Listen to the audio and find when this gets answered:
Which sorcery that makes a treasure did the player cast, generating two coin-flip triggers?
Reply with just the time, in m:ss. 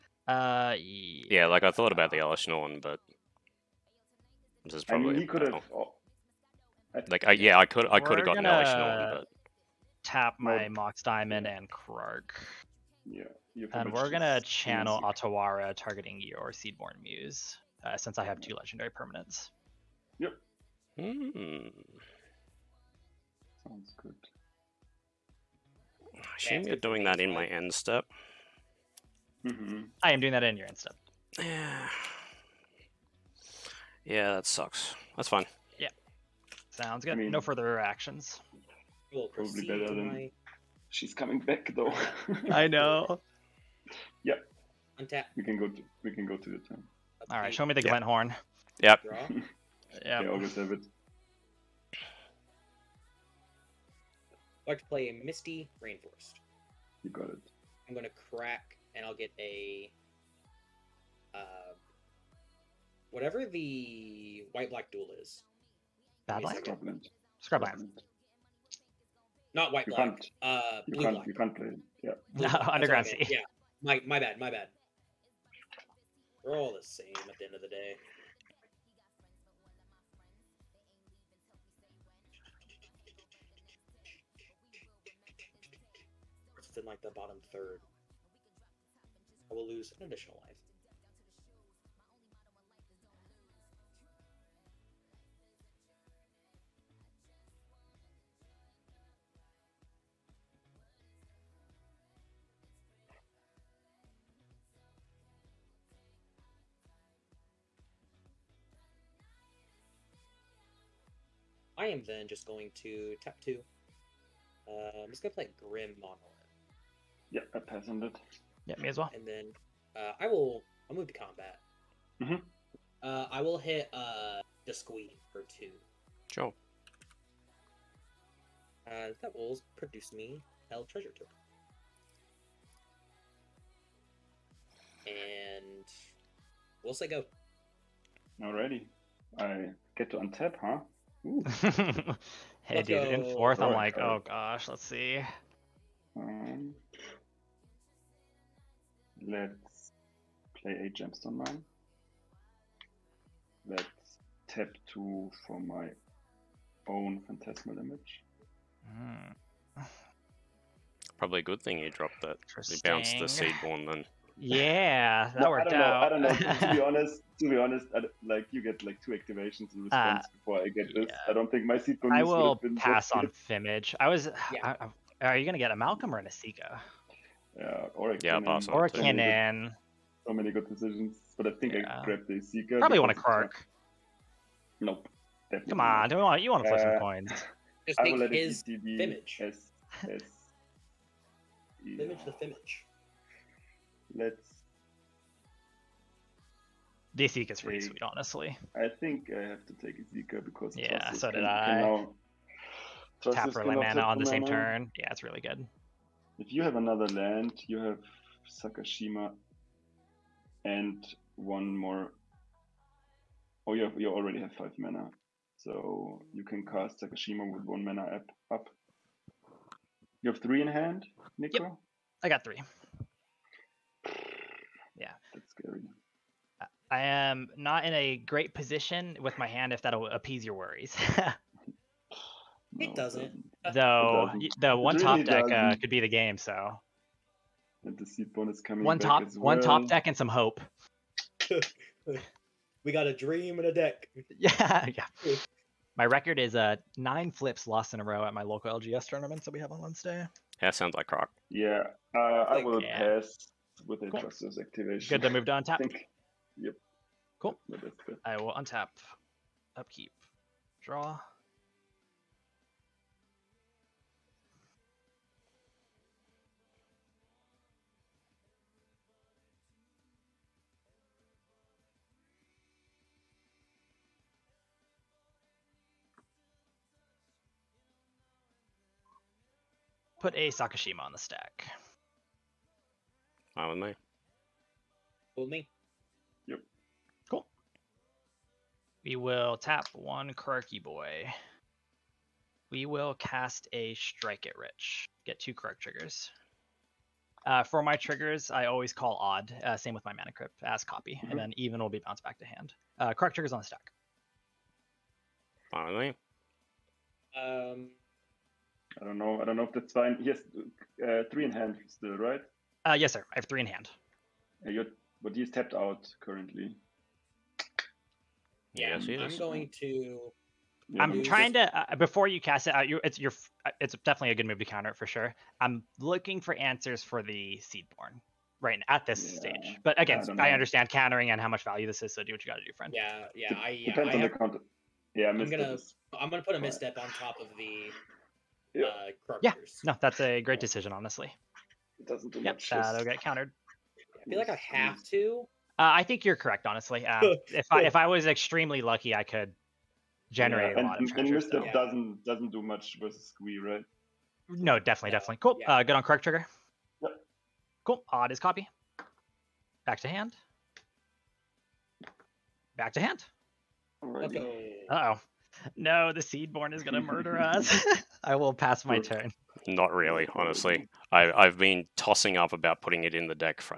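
4:53.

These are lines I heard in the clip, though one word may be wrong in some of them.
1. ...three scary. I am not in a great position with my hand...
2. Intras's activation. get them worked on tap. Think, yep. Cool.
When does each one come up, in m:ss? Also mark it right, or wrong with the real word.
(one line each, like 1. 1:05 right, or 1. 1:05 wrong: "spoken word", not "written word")
1. 3:42 right
2. 4:14 wrong: "moved", not "worked".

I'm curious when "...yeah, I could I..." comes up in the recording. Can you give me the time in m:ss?
0:07.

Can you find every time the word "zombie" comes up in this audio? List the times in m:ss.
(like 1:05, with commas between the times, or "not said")
not said.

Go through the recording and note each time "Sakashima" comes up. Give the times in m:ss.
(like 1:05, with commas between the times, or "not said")
3:28, 3:36, 4:40.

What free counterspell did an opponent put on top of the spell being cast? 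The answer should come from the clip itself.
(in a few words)
Misstep.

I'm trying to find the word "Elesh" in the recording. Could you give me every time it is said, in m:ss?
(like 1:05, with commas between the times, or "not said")
0:02, 0:08.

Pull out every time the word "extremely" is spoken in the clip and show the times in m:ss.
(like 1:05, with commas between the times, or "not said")
5:48.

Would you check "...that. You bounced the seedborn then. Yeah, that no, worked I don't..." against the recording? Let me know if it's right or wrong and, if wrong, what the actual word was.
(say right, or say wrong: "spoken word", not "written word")
right.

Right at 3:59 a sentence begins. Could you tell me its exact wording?
one top deck, and some hope.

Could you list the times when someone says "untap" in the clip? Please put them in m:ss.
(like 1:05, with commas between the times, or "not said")
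0:45, 2:20, 4:18.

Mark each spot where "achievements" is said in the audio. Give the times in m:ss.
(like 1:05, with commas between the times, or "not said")
not said.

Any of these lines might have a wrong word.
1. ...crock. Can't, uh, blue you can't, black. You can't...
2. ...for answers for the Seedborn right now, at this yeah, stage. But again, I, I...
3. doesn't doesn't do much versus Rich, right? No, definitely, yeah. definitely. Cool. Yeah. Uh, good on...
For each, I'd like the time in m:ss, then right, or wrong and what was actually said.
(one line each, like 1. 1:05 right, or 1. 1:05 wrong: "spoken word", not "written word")
1. 1:09 wrong: "black", not "crock"
2. 5:26 right
3. 5:51 wrong: "Squee", not "Rich".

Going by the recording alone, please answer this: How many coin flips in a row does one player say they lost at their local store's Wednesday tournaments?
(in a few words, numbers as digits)
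9.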